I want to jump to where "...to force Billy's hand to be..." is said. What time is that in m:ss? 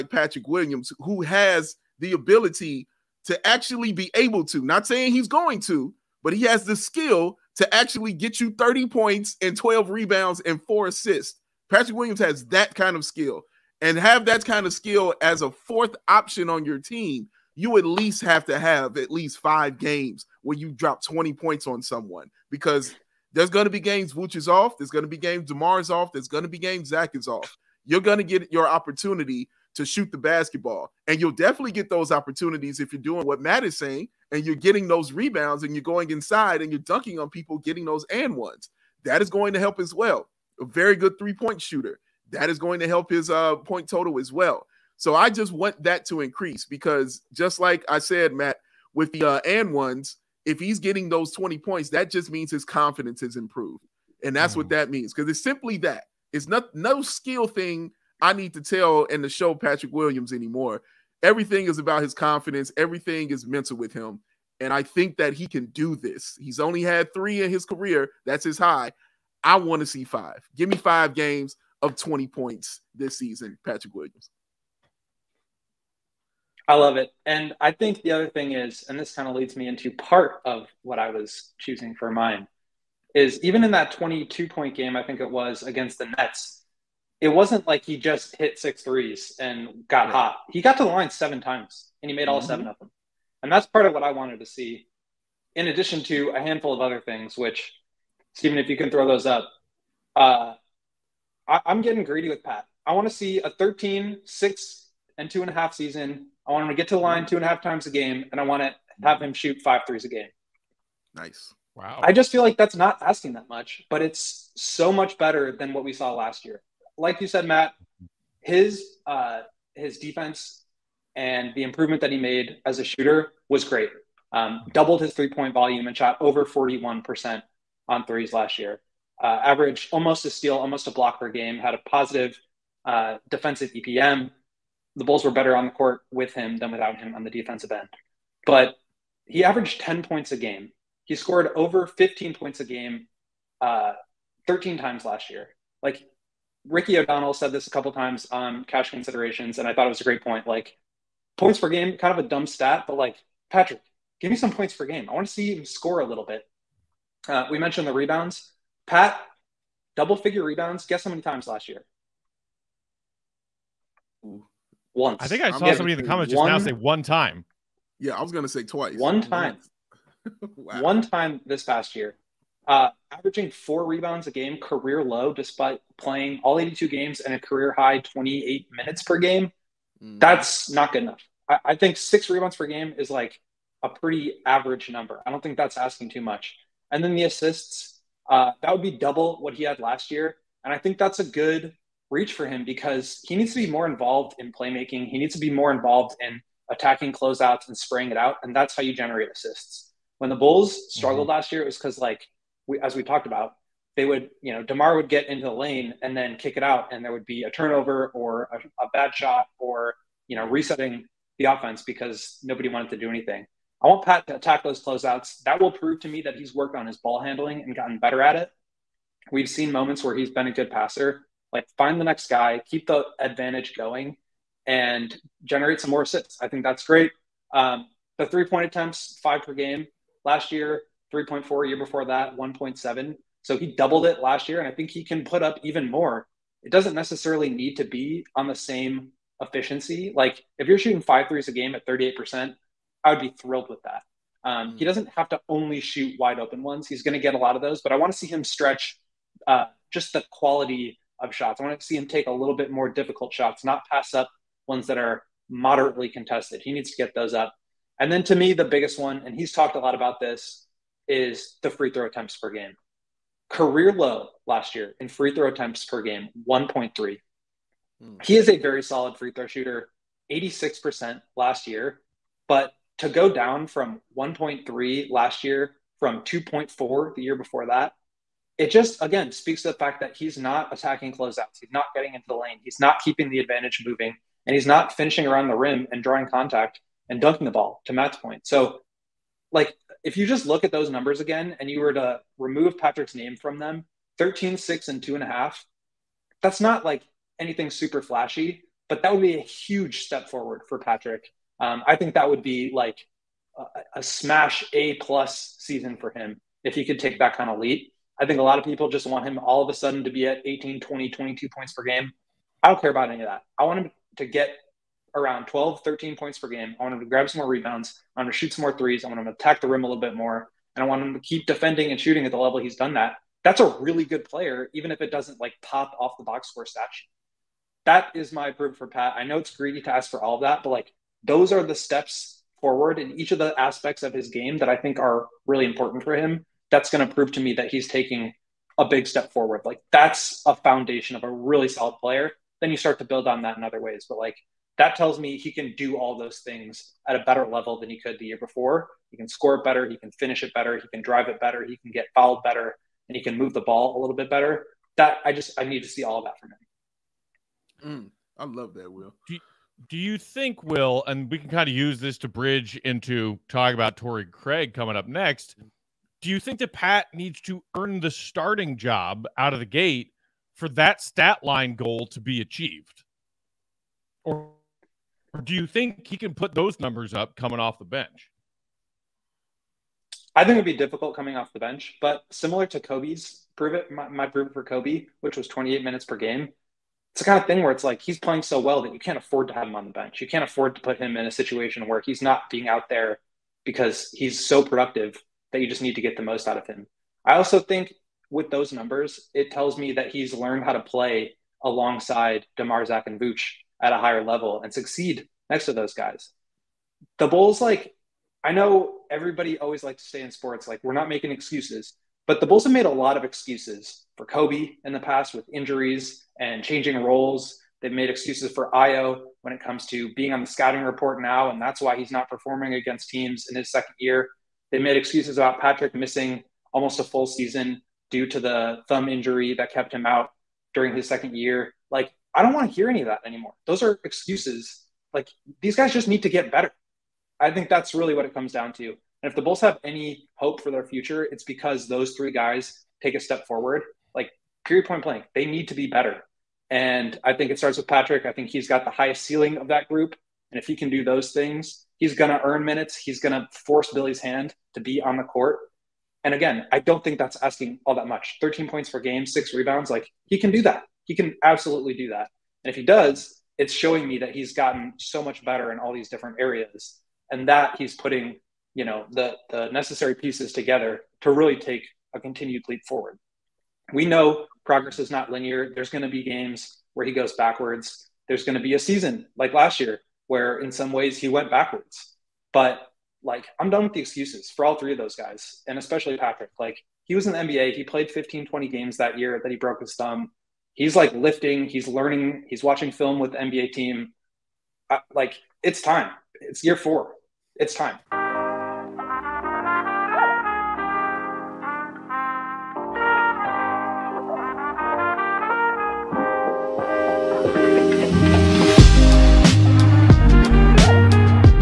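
7:33.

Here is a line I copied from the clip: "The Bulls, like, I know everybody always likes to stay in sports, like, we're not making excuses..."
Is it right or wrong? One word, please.
right.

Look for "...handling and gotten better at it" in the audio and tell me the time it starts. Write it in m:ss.
3:37.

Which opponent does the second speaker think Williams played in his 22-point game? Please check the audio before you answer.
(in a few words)
Nets.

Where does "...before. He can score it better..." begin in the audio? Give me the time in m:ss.
5:48.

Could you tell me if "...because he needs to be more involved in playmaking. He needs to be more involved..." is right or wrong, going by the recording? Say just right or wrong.
right.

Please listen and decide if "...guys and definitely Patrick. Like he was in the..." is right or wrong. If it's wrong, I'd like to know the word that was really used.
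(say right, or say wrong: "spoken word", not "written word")
wrong: "especially", not "definitely".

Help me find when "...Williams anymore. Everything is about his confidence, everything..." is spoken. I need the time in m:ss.
0:59.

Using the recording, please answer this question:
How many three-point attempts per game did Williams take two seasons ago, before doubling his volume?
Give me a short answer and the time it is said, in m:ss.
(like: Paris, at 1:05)
1.7, at 3:52.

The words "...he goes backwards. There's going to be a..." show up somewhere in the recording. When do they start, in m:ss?
7:57.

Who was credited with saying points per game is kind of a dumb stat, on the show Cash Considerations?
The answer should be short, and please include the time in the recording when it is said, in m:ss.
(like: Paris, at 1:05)
Ricky O'Donnell, at 2:26.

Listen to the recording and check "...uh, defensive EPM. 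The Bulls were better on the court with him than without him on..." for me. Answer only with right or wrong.
right.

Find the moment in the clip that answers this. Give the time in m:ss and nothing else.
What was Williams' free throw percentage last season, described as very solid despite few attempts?
4:30.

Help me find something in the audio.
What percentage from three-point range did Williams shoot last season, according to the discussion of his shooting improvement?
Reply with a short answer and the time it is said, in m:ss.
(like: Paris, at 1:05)
over 41%, at 2:06.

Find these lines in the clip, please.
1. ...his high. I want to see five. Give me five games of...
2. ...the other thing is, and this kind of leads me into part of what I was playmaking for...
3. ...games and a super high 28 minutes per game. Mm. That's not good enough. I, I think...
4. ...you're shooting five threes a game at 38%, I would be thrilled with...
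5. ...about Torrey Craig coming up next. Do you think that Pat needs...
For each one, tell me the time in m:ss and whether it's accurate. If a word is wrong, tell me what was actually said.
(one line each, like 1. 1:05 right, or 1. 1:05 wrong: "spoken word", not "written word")
1. 1:08 right
2. 1:18 wrong: "choosing", not "playmaking"
3. 2:56 wrong: "career", not "super"
4. 4:00 right
5. 6:03 right.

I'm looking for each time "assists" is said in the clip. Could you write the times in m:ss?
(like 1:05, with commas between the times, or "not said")
0:10, 3:07, 3:19, 3:46.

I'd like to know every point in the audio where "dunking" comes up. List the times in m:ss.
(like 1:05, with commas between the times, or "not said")
0:36, 4:47.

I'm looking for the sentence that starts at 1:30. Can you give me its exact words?
He got to the line seven times and he made all mm-hmm.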